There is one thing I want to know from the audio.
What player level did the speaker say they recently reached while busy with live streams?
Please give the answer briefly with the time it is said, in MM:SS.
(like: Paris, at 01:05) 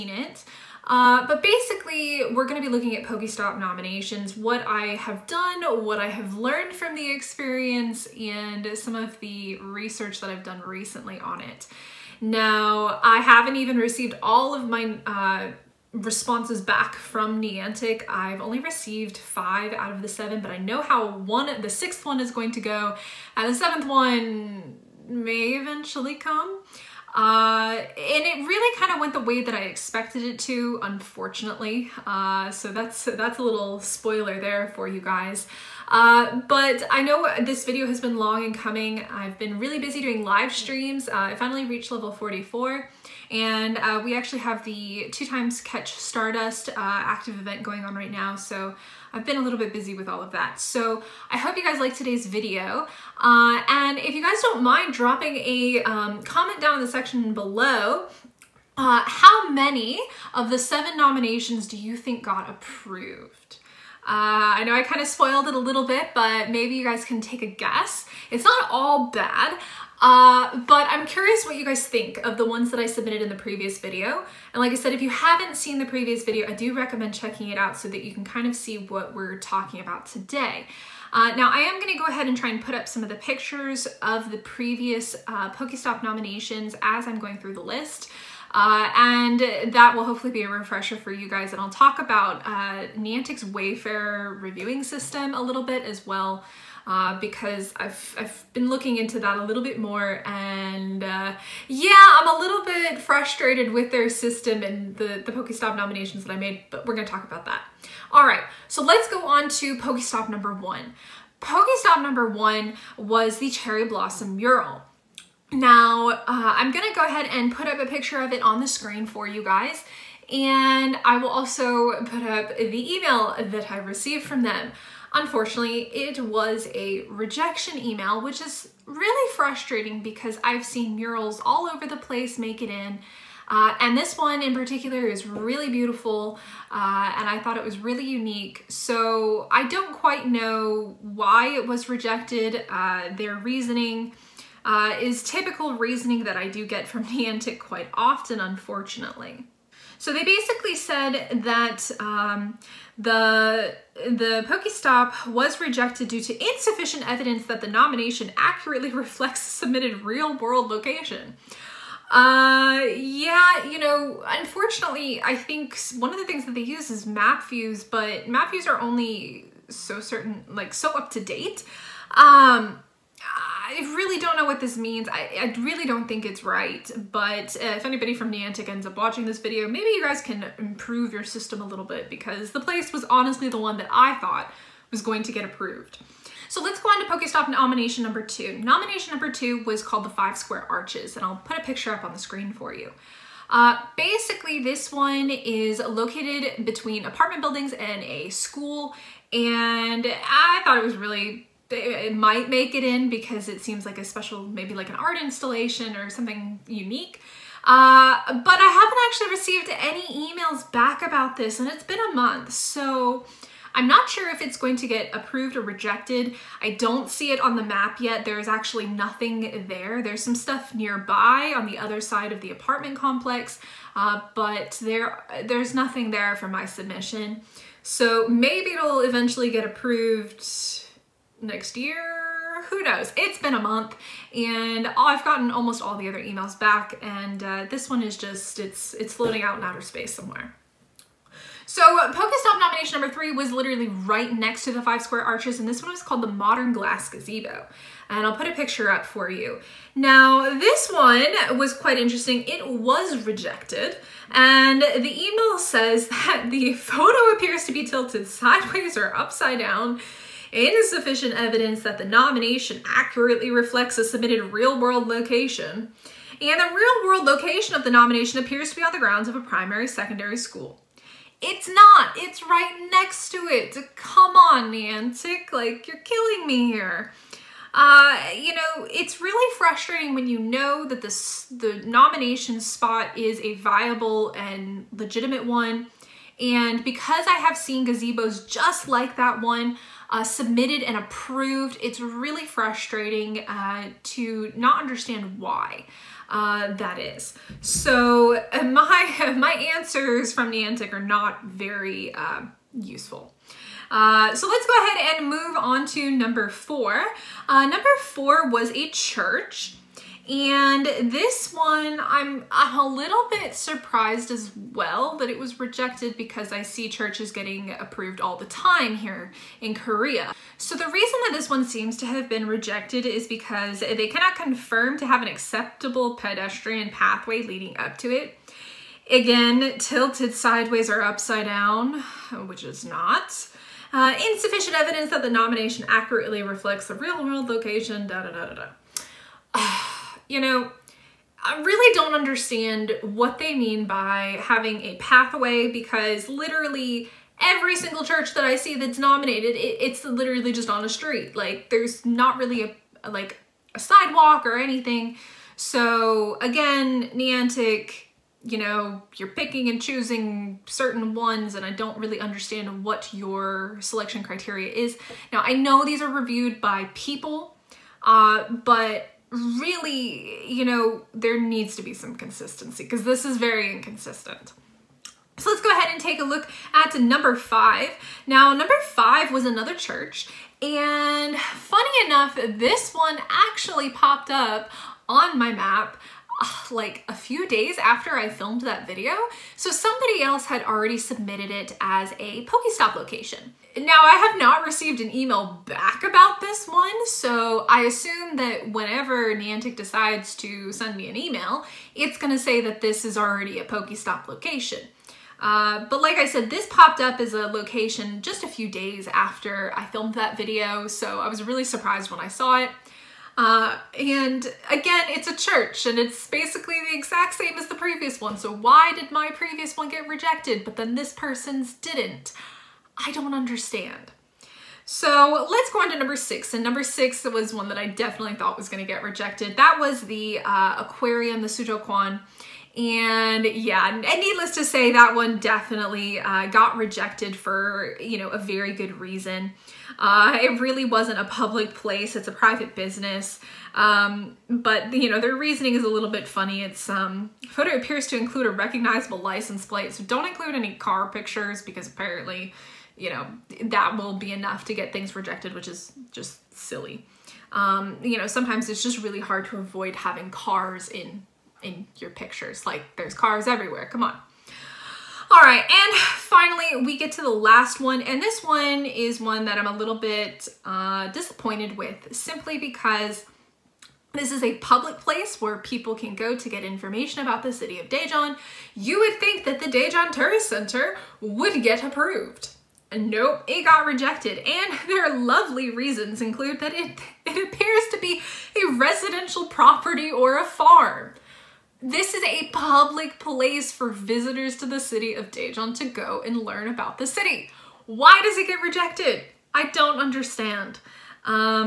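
44, at 00:41.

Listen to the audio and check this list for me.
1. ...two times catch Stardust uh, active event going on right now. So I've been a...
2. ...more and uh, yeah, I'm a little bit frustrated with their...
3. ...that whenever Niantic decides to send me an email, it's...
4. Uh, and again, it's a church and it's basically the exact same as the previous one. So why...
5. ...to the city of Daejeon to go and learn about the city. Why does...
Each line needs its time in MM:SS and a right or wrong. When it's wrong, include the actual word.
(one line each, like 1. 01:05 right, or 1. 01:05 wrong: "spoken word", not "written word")
1. 00:45 right
2. 01:39 right
3. 06:38 right
4. 06:53 right
5. 08:14 right.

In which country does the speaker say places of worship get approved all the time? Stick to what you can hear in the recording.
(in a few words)
Korea.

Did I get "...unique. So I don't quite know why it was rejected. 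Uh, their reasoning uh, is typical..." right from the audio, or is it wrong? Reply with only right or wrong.
right.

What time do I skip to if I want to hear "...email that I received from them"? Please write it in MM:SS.
02:02.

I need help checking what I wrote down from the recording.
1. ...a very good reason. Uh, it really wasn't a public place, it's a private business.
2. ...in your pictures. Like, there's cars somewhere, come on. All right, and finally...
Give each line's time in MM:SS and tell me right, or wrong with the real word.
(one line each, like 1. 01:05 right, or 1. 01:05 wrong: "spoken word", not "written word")
1. 07:18 right
2. 07:41 wrong: "everywhere", not "somewhere".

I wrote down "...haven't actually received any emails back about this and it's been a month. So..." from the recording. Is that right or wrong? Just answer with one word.
right.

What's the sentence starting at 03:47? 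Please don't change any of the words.
So maybe it'll eventually get approved next year.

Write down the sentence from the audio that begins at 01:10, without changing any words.
Uh, but I'm curious what you guys think of the ones that I submitted in the previous video.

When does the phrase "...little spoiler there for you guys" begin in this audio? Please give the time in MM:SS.
00:33.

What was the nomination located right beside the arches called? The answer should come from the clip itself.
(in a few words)
Modern Glass Gazebo.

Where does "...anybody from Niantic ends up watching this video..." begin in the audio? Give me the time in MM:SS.
02:57.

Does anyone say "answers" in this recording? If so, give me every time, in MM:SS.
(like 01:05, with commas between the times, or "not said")
04:59.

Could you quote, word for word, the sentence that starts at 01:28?
Uh, and that will hopefully be a refresher for you guys.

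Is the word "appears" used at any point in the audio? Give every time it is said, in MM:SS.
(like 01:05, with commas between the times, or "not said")
04:17, 04:28, 07:27, 08:07.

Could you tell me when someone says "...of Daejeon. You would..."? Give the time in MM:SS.
07:57.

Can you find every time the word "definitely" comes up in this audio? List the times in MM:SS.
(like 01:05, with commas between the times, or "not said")
07:07, 07:15.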